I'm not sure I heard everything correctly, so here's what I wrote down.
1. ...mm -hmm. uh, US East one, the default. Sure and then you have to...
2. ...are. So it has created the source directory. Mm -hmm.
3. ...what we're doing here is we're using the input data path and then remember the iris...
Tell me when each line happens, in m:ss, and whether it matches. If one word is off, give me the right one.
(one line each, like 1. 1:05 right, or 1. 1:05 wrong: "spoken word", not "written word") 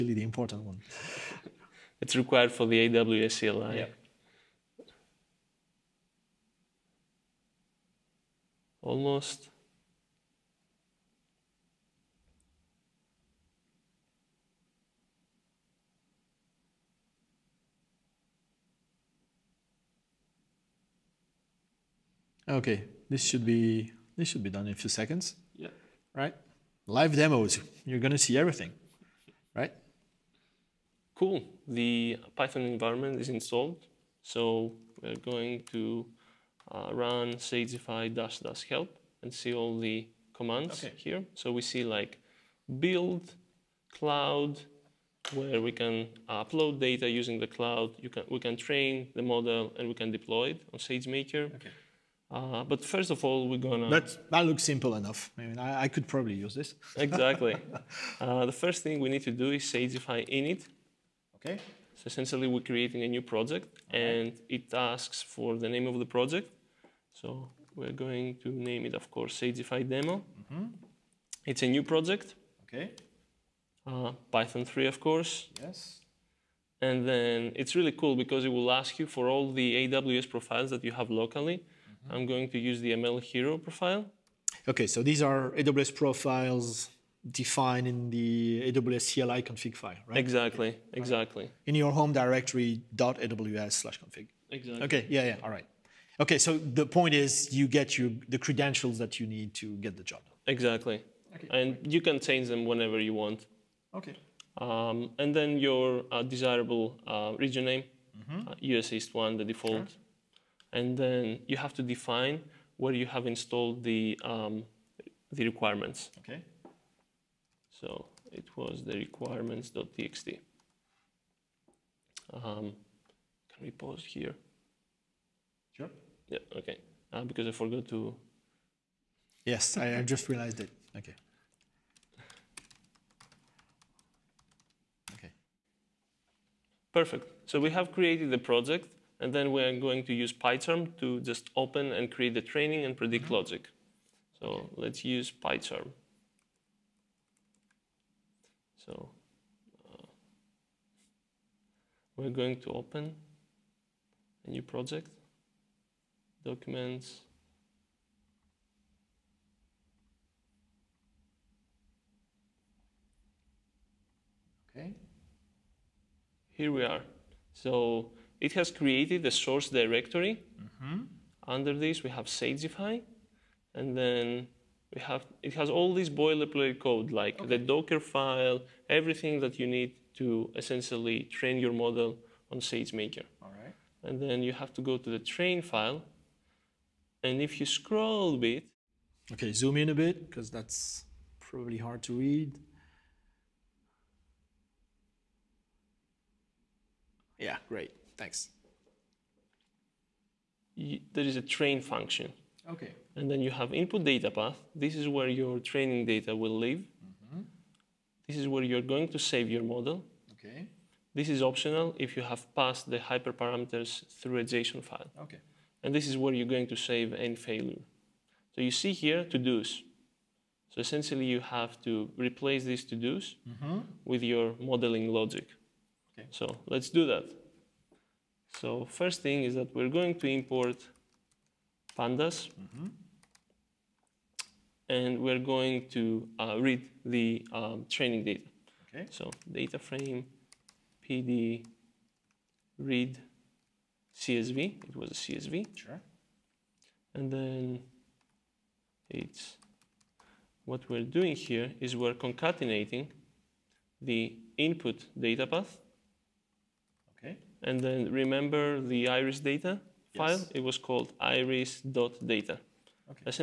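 1. 1:47 right
2. 2:46 right
3. 4:10 wrong: "concatenating", not "using".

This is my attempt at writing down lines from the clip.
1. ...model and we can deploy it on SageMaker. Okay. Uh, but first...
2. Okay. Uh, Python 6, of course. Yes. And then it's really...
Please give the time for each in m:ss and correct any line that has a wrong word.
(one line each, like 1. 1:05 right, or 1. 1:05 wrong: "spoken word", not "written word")
1. 0:49 right
2. 1:12 wrong: "3", not "6".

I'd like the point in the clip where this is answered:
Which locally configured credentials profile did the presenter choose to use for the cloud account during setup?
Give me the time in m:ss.
1:22.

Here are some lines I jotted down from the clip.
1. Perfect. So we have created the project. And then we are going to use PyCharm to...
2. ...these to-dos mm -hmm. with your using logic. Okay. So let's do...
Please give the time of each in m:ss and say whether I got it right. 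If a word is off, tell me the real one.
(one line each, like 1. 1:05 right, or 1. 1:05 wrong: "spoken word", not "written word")
1. 2:16 right
2. 3:42 wrong: "modeling", not "using".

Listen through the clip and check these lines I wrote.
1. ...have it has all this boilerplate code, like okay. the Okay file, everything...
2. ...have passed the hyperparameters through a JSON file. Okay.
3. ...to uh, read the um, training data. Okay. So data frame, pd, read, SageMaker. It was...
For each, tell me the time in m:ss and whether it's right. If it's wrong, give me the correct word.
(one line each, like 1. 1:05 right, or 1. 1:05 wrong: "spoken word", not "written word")
1. 2:55 wrong: "Docker", not "Okay"
2. 3:32 right
3. 3:55 wrong: "CSV", not "SageMaker".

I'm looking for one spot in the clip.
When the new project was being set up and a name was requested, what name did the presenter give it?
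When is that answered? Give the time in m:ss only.
1:09.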